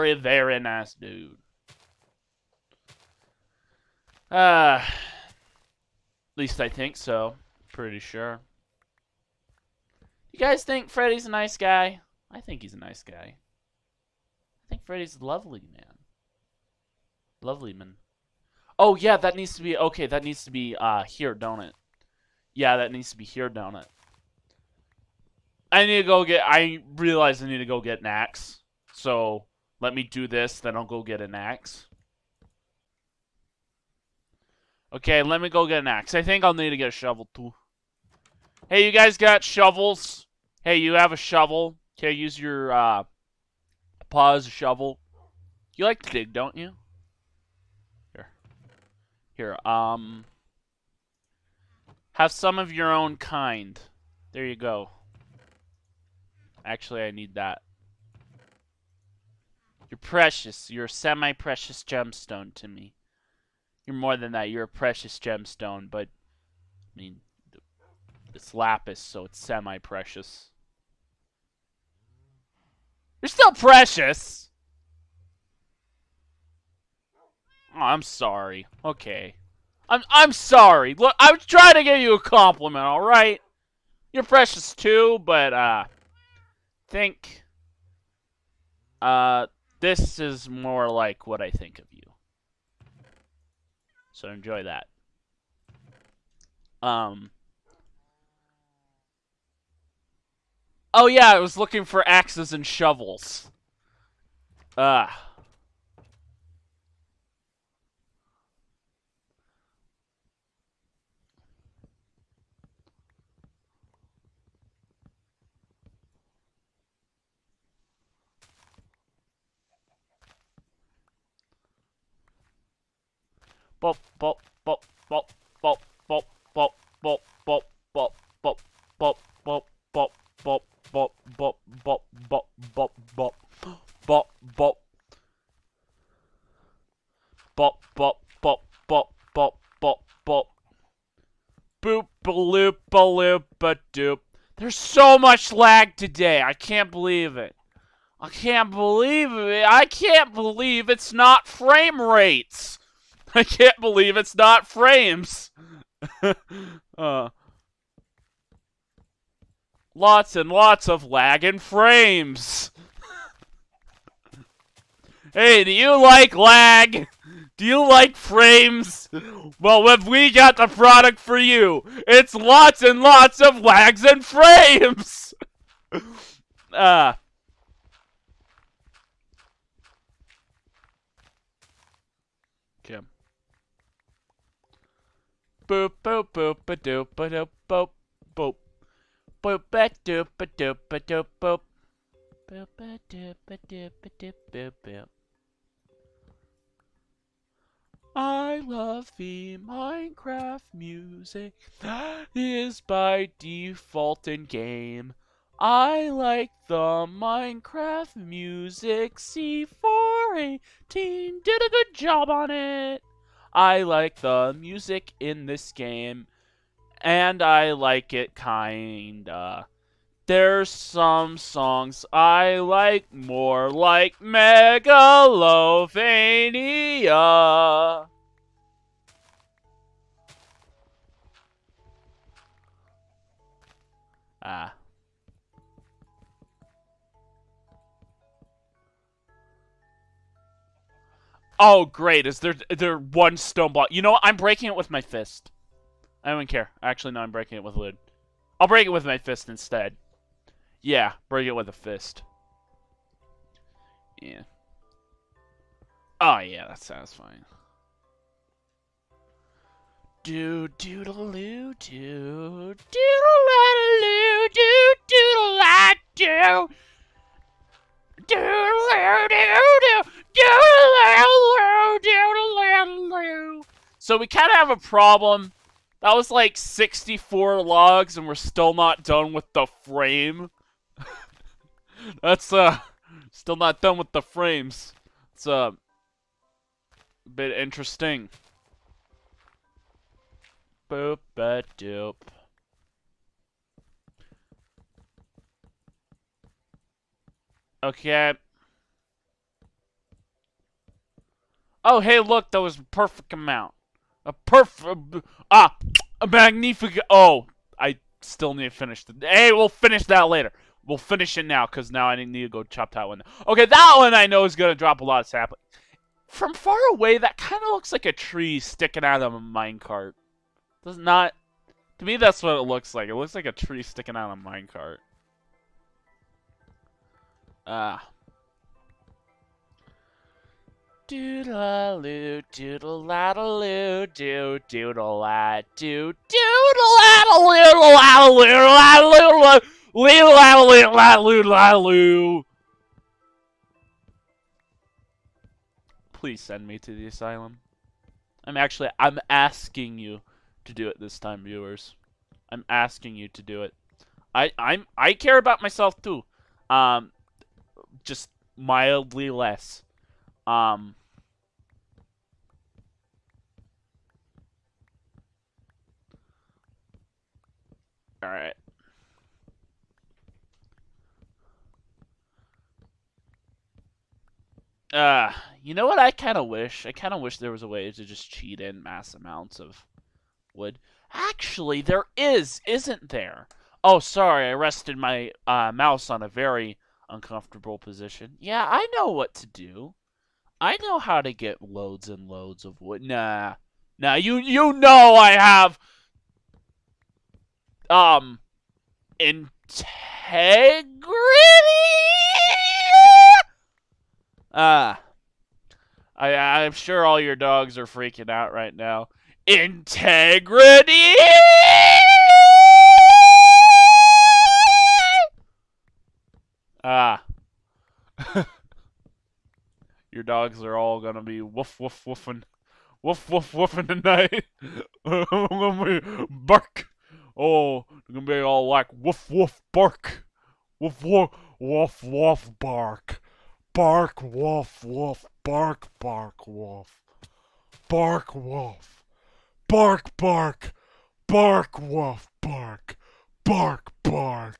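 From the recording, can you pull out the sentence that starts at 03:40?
There's some songs I like more, like Megalovania.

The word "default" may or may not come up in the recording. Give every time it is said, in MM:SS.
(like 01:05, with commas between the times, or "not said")
03:23.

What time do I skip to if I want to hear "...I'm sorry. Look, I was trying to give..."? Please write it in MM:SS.
01:20.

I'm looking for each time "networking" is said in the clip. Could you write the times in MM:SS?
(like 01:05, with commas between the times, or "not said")
not said.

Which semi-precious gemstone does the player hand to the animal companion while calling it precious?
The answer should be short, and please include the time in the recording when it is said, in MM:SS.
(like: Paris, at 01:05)
Lapis, at 01:08.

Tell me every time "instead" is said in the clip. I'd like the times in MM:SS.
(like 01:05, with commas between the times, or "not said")
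04:09.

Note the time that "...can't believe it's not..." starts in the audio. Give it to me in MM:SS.
02:33.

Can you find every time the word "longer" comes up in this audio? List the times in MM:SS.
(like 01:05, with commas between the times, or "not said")
not said.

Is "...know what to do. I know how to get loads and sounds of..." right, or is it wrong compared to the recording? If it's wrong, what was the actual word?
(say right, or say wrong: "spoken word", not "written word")
wrong: "loads", not "sounds".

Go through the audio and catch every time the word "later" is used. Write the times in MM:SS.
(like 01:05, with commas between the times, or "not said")
05:10.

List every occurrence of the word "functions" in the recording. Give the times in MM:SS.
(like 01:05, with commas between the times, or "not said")
not said.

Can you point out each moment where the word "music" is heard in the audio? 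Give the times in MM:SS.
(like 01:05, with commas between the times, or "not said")
03:20, 03:28, 03:34.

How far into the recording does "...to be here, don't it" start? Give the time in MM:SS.
00:23.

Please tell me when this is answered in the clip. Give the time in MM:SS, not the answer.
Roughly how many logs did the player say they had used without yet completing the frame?
04:36.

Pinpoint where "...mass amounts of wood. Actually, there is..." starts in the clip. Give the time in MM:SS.
06:18.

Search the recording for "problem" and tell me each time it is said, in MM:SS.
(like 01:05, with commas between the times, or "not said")
04:34.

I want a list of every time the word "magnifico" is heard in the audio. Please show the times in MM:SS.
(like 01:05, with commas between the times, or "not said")
05:06.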